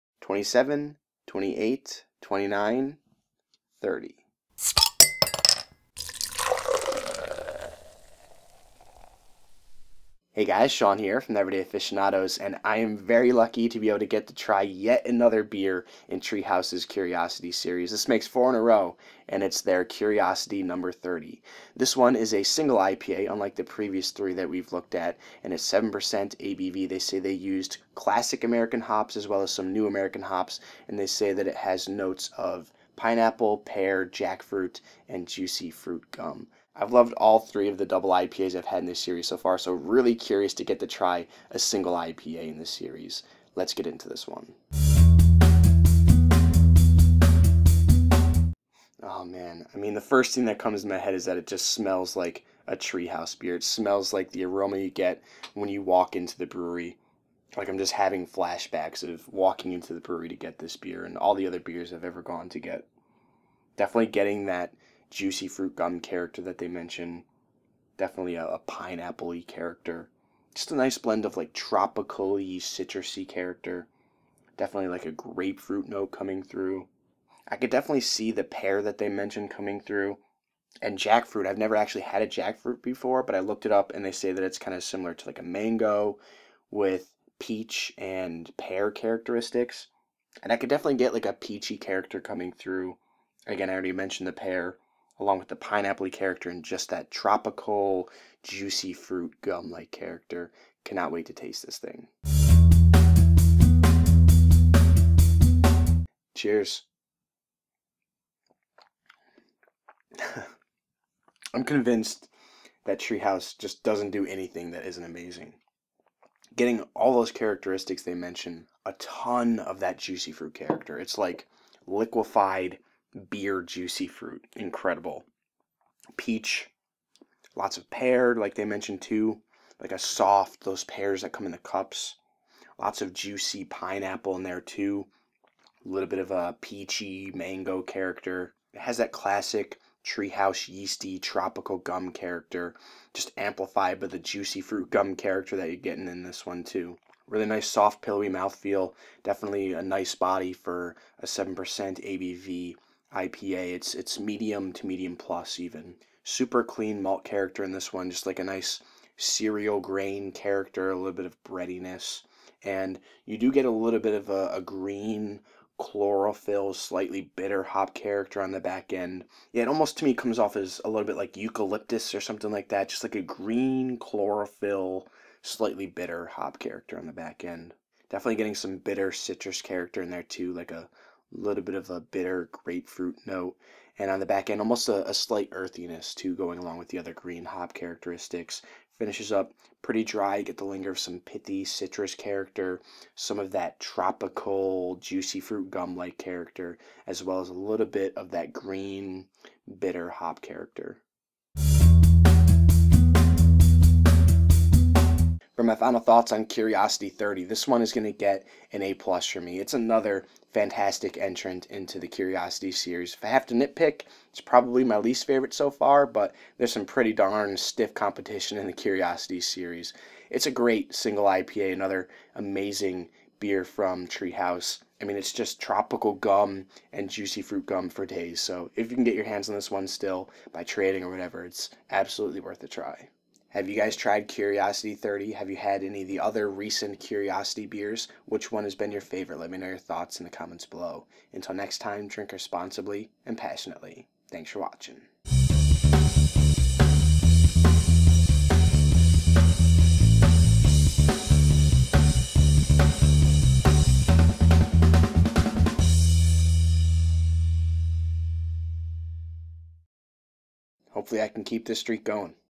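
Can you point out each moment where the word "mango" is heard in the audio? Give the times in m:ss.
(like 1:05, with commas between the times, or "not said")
1:25, 2:17.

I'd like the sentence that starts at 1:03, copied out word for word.
Definitely getting that juicy fruit gum character that they mention.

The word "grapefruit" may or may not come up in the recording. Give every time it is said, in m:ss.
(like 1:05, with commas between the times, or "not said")
1:15, 3:02.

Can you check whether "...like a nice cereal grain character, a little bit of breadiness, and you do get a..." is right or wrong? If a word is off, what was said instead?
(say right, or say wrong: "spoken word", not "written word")
right.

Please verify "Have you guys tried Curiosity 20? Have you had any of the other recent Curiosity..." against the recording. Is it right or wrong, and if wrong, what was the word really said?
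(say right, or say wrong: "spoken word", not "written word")
wrong: "30", not "20".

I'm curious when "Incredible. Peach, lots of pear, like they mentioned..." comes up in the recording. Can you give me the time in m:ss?
2:04.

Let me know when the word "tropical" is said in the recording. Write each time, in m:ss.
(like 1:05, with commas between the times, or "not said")
1:11, 1:37, 2:21, 3:13, 3:45.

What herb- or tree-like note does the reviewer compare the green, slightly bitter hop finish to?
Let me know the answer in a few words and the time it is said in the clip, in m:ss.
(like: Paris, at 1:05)
eucalyptus, at 2:51.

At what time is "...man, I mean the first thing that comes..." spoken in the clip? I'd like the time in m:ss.
0:49.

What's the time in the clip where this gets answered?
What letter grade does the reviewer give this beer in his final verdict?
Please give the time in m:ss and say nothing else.
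3:28.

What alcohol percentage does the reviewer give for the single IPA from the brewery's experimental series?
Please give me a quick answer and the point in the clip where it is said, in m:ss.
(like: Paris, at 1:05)
7%, at 0:25.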